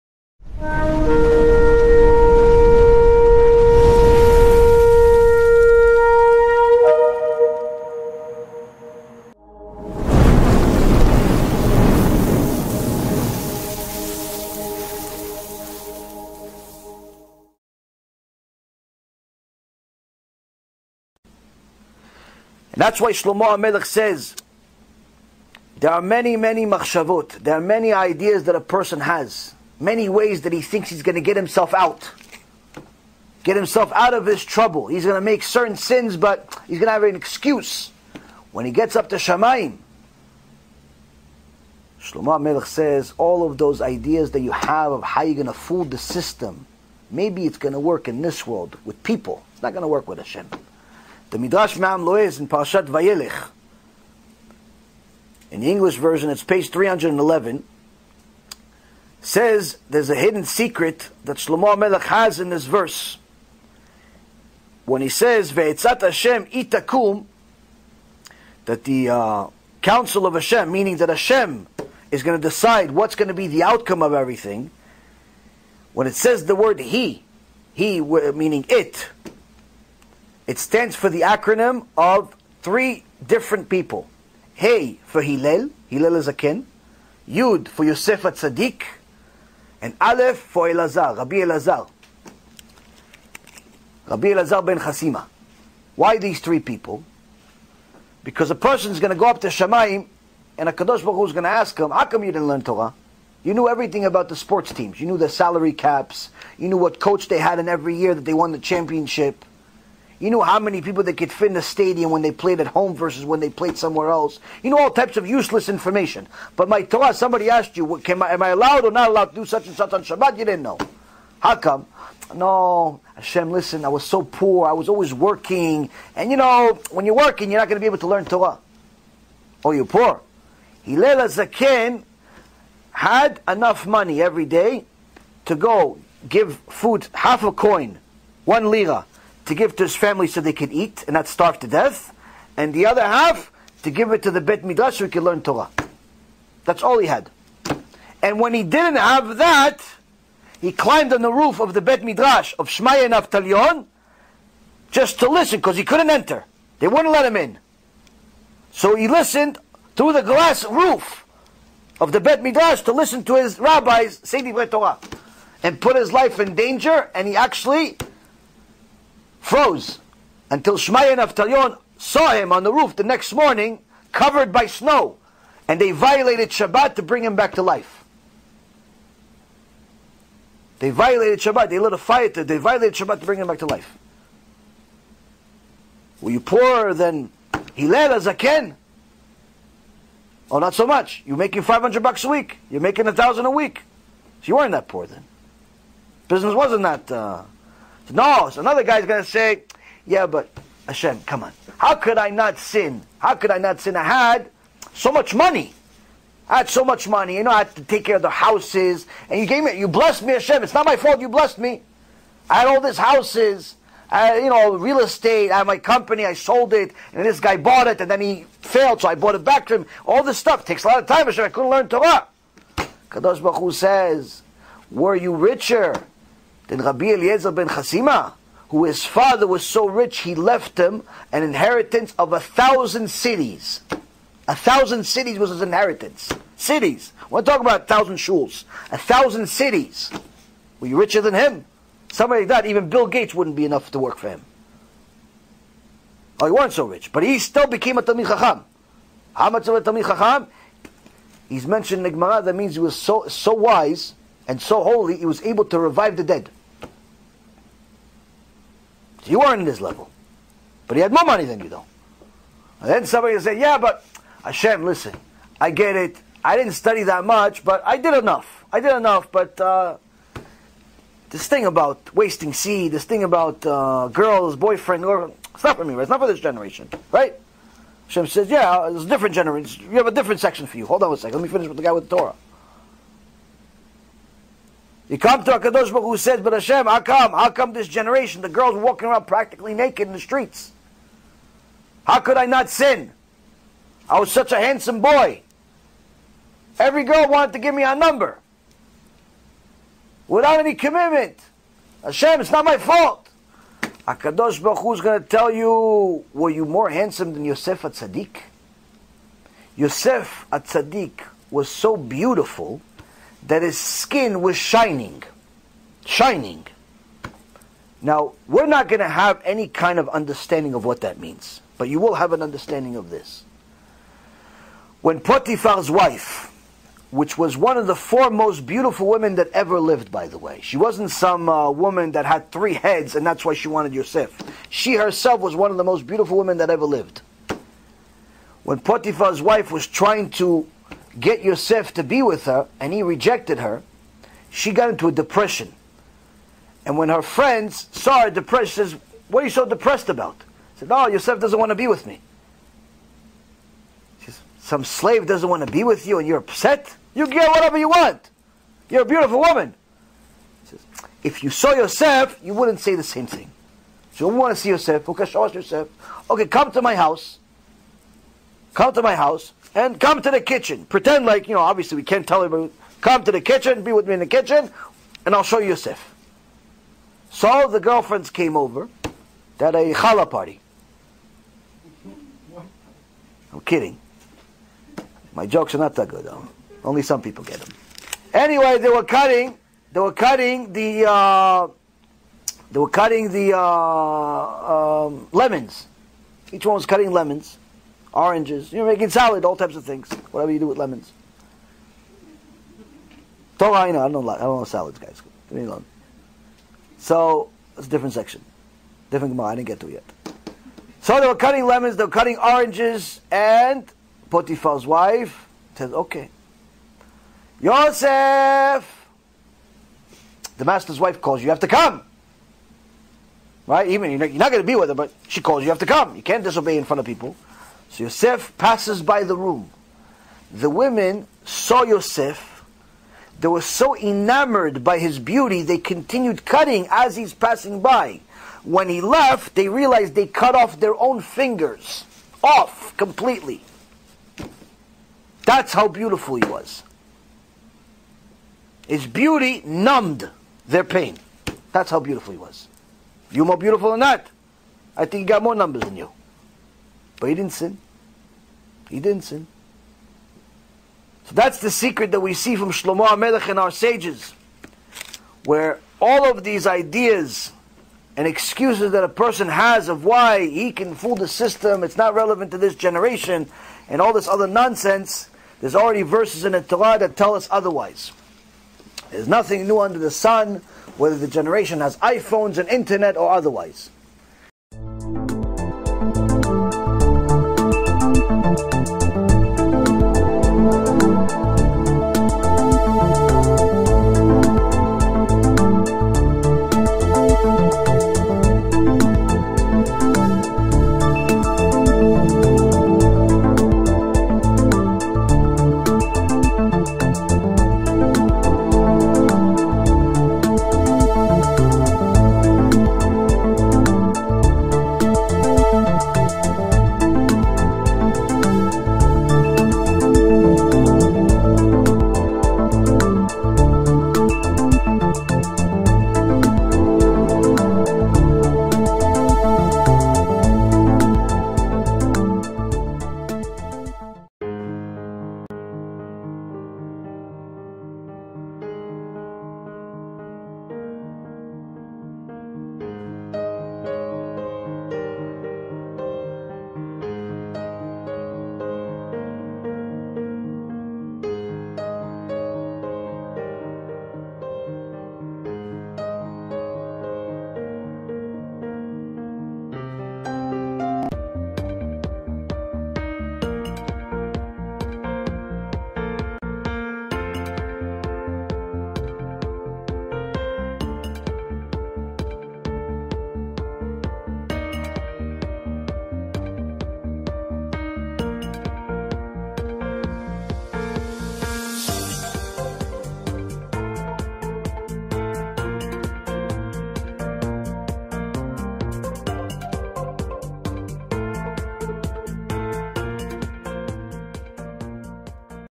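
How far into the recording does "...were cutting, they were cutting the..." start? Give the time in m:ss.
6:28.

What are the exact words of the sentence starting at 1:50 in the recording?
You know how many people that could fit in the stadium when they played at home versus when they played somewhere else.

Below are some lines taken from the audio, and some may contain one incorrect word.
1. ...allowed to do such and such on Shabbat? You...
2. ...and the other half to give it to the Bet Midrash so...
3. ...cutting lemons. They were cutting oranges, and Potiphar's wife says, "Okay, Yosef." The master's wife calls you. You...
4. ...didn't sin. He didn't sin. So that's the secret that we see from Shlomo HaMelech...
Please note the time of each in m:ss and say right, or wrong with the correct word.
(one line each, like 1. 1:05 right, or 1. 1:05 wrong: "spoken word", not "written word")
1. 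1:59 right
2. 2:22 right
3. 6:51 right
4. 7:37 right.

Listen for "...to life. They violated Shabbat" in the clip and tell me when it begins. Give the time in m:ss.
2:57.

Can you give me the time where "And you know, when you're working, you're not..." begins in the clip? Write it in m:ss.
2:06.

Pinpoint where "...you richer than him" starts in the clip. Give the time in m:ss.
4:00.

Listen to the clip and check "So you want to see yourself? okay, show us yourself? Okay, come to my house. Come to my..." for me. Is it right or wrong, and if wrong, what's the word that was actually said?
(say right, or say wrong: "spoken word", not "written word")
right.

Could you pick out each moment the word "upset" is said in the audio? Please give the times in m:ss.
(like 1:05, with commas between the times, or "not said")
5:56.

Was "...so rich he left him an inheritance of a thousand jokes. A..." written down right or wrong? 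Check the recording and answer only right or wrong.
wrong.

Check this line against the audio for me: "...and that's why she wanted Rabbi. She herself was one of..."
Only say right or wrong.
wrong.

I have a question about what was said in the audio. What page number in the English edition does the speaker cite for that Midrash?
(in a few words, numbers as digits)
311.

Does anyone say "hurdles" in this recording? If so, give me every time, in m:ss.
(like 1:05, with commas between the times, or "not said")
not said.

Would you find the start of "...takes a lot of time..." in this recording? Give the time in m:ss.
3:40.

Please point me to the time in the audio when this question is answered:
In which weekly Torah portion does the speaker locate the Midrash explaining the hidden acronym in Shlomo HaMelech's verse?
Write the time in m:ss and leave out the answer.
0:52.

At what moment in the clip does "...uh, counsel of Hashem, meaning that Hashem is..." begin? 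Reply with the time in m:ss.
1:09.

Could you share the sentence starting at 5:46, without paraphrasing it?
And when her friends saw her depressed, says, What are you so depressed about?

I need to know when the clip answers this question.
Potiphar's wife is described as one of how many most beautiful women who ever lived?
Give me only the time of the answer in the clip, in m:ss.
5:27.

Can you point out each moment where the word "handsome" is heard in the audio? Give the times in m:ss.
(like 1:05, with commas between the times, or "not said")
4:54, 5:06.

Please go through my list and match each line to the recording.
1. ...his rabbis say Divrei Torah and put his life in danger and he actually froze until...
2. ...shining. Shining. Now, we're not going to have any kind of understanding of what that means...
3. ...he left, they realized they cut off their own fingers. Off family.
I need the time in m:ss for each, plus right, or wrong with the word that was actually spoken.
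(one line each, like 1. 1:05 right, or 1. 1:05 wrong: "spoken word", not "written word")
1. 2:43 right
2. 5:14 right
3. 7:18 wrong: "completely", not "family".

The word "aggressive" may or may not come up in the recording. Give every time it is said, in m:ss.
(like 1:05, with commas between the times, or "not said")
not said.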